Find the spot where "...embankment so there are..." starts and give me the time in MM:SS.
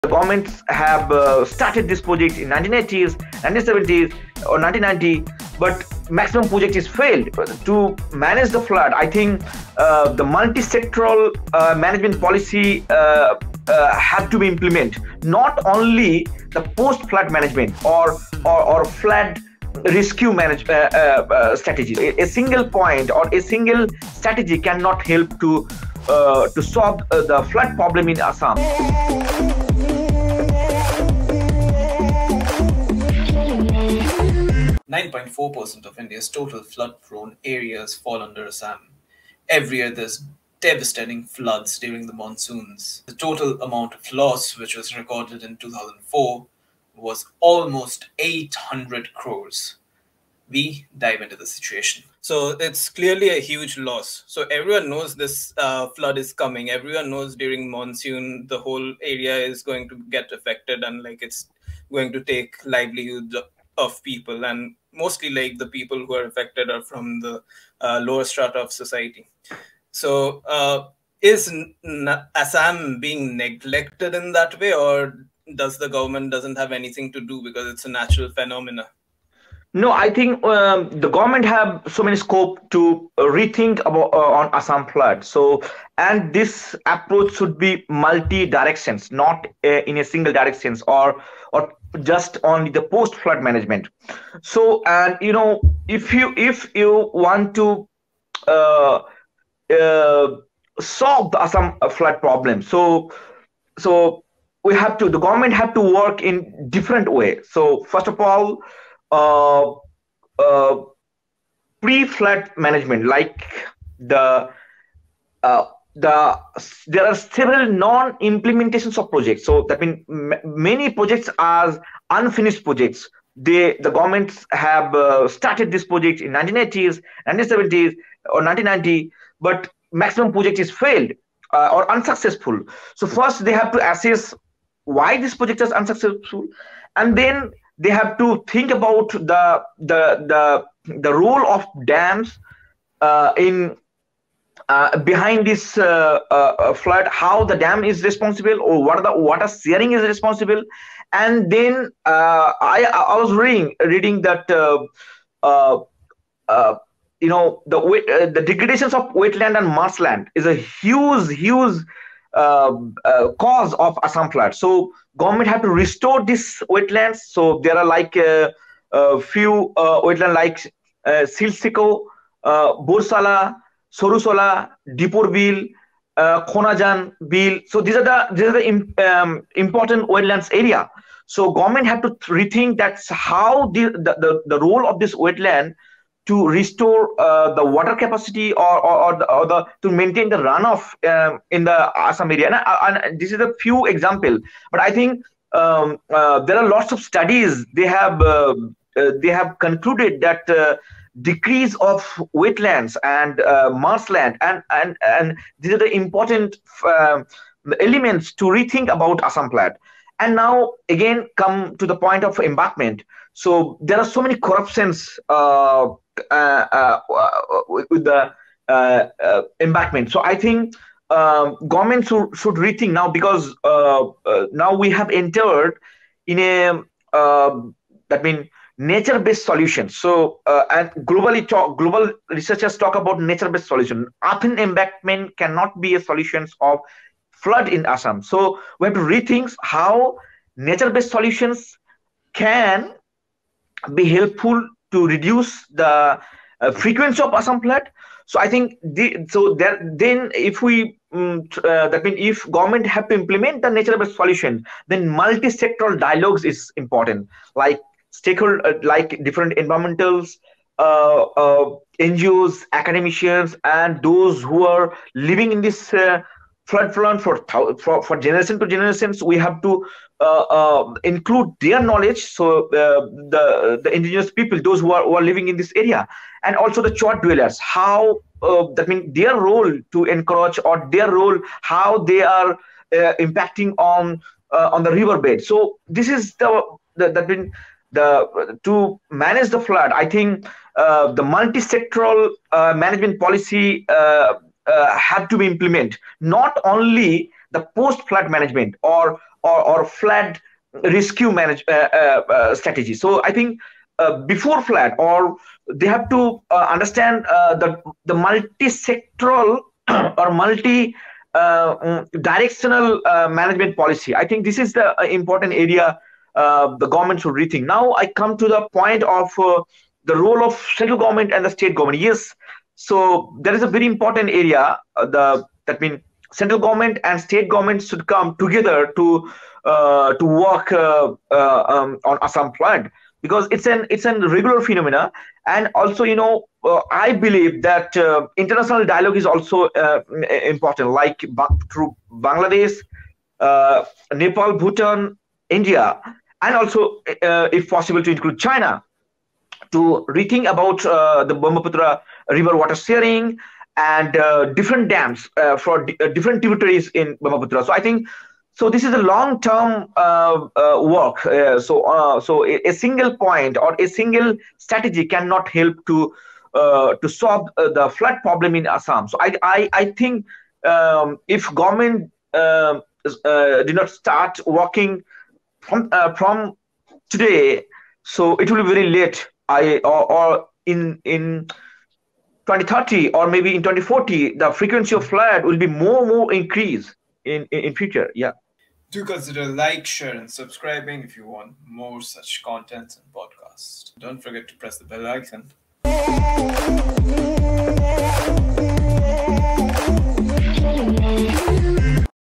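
03:32.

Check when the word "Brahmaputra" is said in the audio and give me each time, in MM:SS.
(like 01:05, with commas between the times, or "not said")
05:51, 05:57.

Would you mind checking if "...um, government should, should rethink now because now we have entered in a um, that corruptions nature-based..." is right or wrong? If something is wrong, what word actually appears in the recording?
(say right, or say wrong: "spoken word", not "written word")
wrong: "means", not "corruptions".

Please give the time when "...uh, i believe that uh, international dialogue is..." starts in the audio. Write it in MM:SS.
05:36.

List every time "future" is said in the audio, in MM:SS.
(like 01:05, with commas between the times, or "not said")
06:27.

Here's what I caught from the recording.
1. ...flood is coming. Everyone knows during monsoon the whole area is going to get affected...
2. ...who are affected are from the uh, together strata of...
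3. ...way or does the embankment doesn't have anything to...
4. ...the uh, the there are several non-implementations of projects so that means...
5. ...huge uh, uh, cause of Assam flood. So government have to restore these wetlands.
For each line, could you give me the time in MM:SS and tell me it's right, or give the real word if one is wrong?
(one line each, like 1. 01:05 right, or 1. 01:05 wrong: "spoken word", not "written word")
1. 00:55 right
2. 01:06 wrong: "lower", not "together"
3. 01:14 wrong: "government", not "embankment"
4. 01:53 right
5. 02:41 right.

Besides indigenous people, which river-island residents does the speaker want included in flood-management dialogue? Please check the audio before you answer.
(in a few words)
Char dwellers.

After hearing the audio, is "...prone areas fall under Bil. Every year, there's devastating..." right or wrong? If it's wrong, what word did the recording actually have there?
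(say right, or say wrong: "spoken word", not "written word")
wrong: "Assam", not "Bil".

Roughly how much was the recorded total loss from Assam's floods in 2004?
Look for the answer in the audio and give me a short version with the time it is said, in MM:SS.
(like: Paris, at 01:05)
800 crores, at 00:48.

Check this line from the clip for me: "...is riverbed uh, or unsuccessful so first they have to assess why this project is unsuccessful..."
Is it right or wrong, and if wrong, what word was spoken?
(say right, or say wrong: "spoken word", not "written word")
wrong: "failed", not "riverbed".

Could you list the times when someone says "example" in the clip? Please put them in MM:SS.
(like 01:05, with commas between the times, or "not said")
03:13.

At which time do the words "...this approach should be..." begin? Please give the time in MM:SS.
01:26.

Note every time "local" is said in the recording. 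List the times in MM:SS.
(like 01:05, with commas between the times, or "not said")
not said.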